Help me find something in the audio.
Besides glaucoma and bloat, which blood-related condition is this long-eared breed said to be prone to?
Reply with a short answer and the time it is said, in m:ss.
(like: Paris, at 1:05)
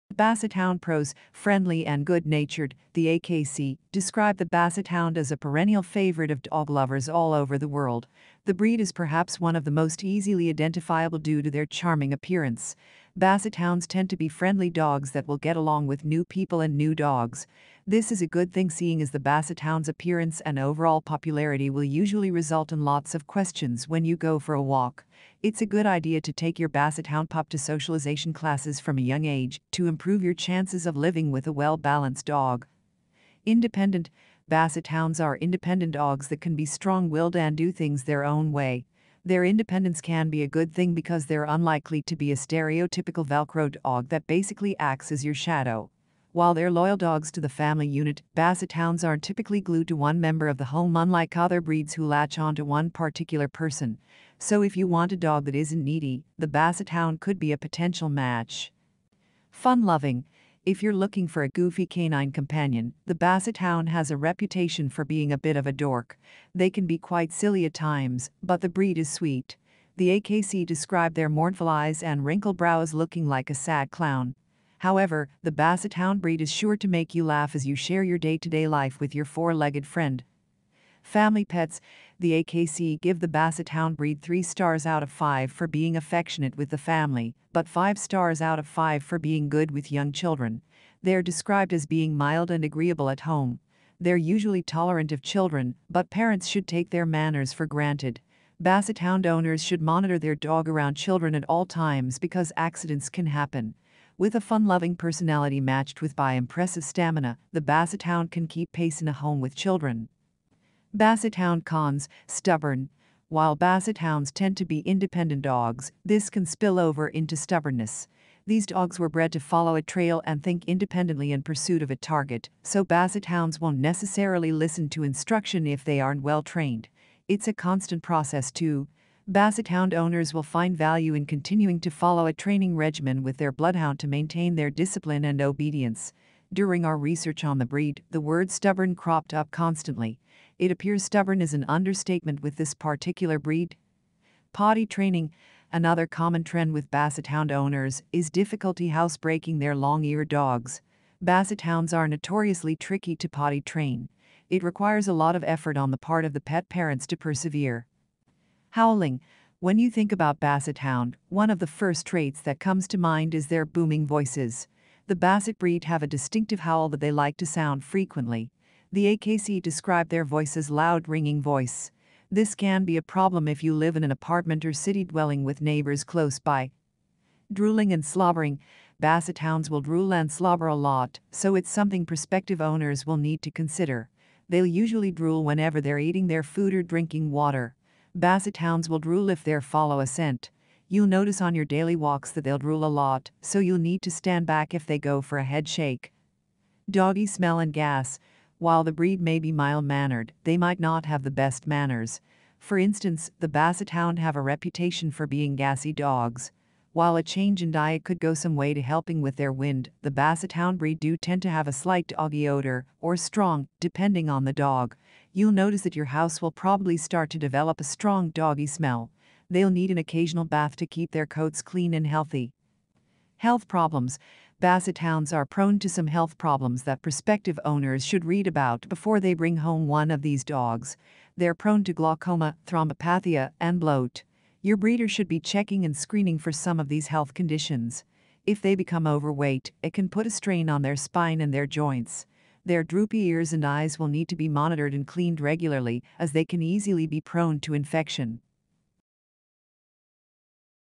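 Thrombopathia, at 3:52.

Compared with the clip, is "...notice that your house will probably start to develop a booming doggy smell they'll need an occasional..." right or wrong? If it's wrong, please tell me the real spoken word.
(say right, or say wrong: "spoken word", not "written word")
wrong: "strong", not "booming".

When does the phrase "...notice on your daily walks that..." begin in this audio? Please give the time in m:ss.
3:11.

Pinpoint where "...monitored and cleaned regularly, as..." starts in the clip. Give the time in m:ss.
4:04.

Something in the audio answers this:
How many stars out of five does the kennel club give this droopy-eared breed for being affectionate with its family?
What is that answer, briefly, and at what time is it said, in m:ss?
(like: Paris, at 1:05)
3, at 1:24.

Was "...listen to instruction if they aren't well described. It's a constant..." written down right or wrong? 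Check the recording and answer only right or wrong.
wrong.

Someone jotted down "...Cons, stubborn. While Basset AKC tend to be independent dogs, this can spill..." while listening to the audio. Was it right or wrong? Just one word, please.
wrong.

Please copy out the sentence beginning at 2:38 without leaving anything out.
Howling, when you think about Basset Hound, one of the first traits that comes to mind is their booming voices.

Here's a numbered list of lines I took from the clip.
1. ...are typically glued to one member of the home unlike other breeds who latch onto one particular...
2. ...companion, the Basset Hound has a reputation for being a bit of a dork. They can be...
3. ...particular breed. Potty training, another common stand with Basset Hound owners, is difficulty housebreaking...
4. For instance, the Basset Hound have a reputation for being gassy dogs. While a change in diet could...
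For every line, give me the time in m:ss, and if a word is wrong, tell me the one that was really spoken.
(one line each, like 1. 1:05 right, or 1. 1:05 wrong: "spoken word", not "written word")
1. 0:49 right
2. 1:02 right
3. 2:22 wrong: "trend", not "stand"
4. 3:22 right.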